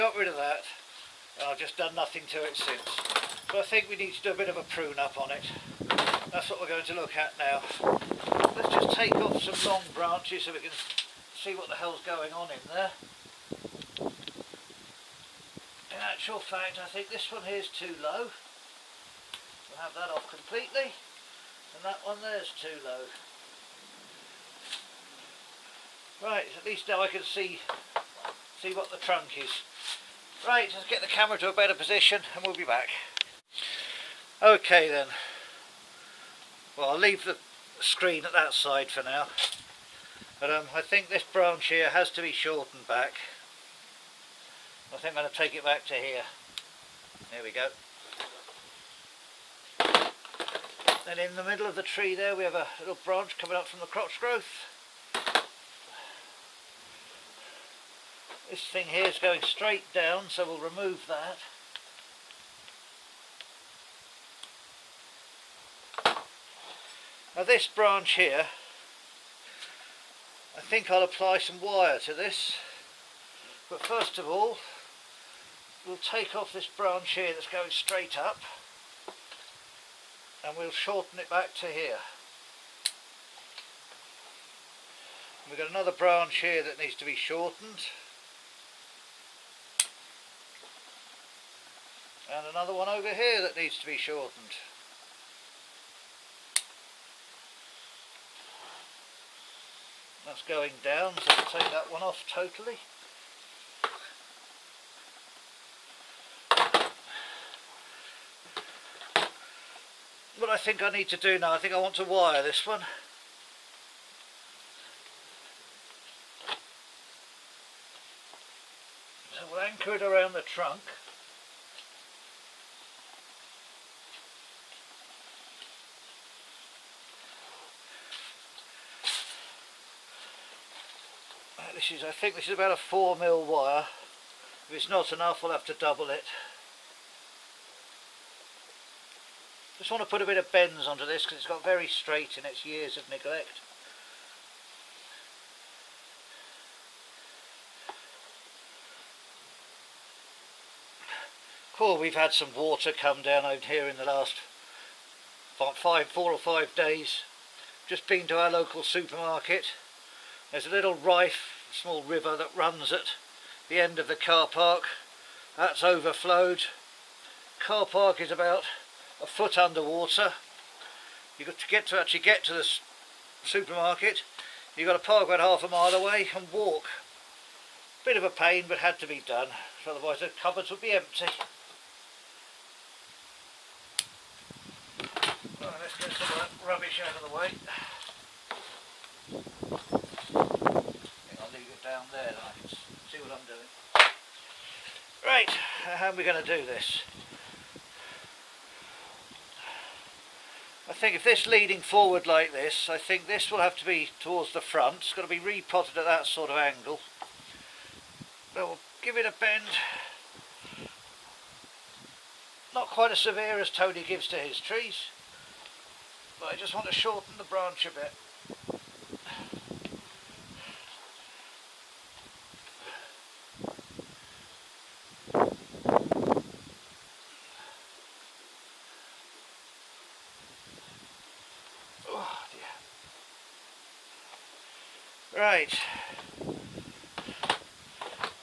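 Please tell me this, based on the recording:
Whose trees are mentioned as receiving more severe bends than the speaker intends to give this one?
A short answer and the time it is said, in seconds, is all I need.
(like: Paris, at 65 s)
Tony, at 213 s.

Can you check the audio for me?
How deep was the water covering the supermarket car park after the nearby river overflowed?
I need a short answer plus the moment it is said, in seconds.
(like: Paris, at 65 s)
about a foot, at 168 s.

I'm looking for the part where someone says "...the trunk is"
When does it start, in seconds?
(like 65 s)
28 s.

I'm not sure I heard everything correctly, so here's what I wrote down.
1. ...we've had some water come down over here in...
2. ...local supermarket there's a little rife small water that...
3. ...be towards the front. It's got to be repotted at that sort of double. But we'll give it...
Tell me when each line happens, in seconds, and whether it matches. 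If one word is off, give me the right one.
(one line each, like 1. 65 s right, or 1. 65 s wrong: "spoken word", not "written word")
1. 151 s right
2. 158 s wrong: "river", not "water"
3. 203 s wrong: "angle", not "double".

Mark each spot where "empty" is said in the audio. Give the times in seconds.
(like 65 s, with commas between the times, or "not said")
180 s.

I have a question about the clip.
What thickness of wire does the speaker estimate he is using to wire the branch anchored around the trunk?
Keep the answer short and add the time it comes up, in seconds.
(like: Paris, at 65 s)
4 mil, at 132 s.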